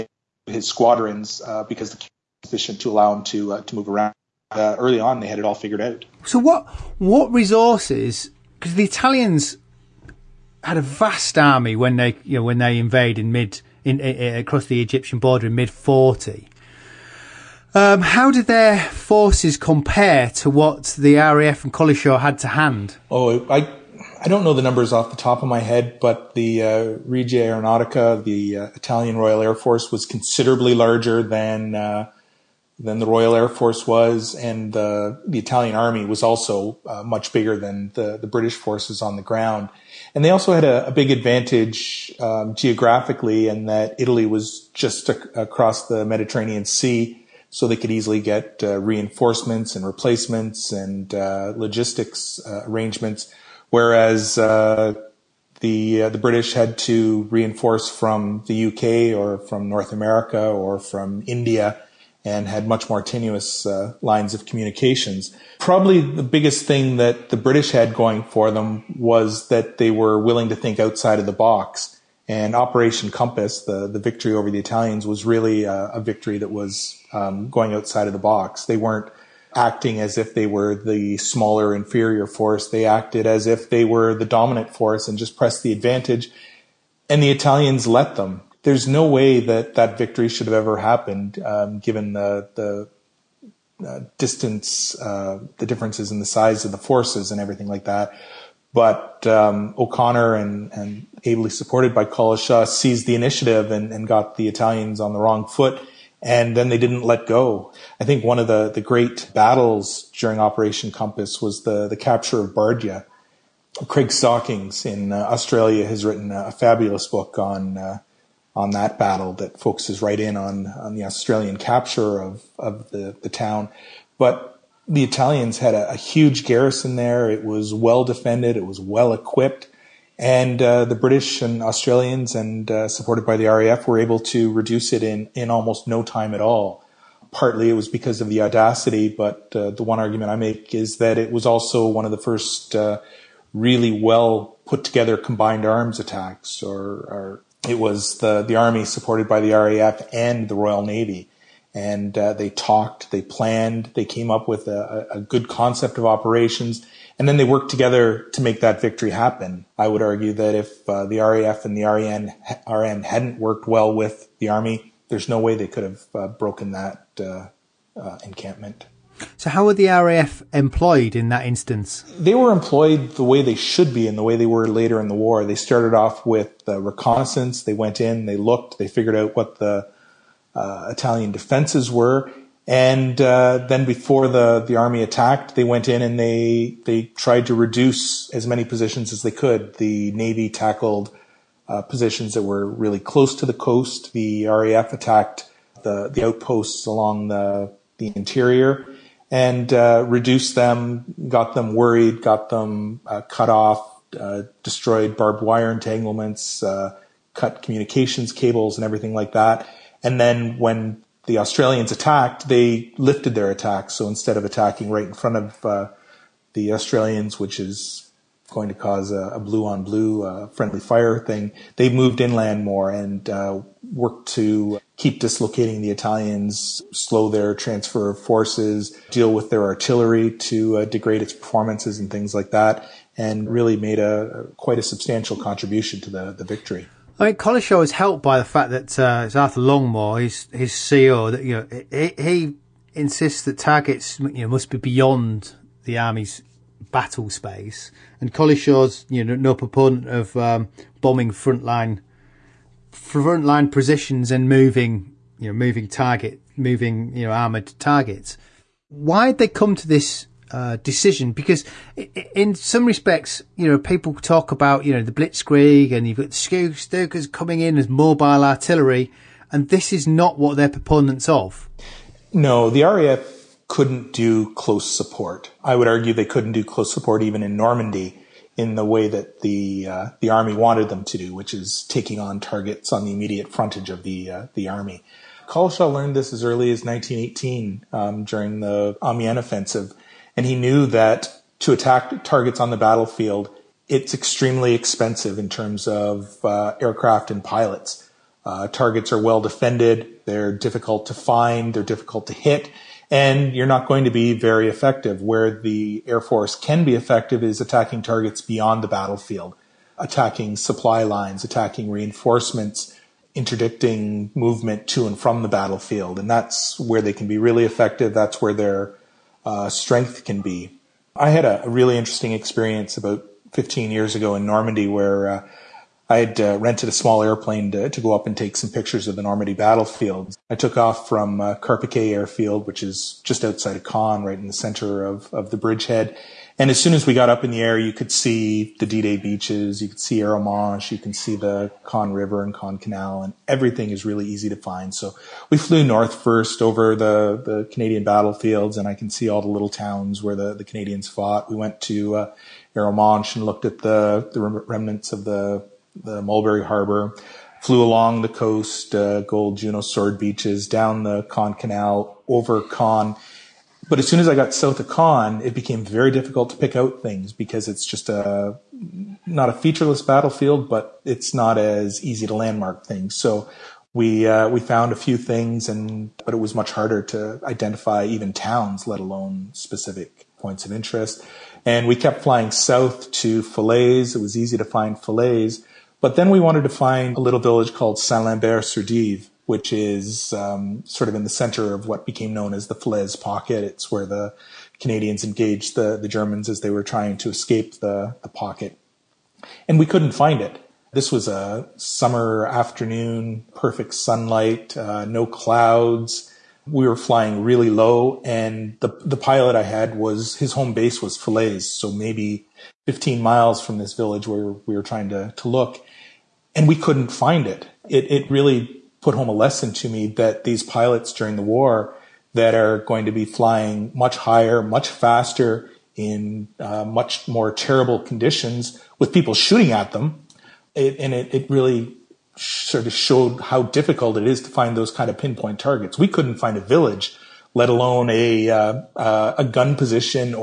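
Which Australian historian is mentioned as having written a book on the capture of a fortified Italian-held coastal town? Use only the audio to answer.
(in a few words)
Craig Stockings.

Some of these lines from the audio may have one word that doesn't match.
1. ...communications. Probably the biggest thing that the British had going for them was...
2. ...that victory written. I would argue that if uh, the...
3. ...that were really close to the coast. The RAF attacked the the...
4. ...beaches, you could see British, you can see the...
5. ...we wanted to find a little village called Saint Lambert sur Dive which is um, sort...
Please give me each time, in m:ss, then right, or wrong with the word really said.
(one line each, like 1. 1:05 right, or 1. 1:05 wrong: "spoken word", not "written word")
1. 1:04 right
2. 2:38 wrong: "happen", not "written"
3. 3:12 right
4. 5:39 wrong: "Arromanches", not "British"
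5. 6:26 right.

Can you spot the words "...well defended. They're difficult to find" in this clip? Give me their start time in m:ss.
4:59.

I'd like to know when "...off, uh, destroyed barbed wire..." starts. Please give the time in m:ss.
3:23.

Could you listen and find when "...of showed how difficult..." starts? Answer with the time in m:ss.
7:12.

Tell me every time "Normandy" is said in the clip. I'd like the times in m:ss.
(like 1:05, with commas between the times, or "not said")
4:37, 5:24, 5:29.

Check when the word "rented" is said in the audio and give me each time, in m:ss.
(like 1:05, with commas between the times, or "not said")
5:26.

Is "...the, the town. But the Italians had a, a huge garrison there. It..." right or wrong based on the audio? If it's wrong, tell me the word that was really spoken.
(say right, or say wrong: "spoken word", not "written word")
right.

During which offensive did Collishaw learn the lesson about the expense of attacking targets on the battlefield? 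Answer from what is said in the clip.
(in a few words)
Amiens offensive.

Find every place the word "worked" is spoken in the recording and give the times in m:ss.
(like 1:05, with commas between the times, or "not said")
2:37, 2:43, 3:43.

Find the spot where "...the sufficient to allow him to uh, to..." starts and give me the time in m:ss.
0:01.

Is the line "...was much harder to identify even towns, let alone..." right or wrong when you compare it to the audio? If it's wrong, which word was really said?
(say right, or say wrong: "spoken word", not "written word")
right.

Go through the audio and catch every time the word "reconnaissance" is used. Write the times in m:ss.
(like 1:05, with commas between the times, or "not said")
2:56.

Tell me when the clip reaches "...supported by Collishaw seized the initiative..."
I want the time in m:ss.
1:41.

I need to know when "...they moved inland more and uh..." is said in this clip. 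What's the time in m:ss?
3:41.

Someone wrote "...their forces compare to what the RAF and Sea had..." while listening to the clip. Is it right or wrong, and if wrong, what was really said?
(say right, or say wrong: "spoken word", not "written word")
wrong: "Collishaw", not "Sea".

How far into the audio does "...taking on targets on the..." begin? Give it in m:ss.
4:41.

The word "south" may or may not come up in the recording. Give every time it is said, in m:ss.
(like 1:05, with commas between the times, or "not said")
6:04, 6:22.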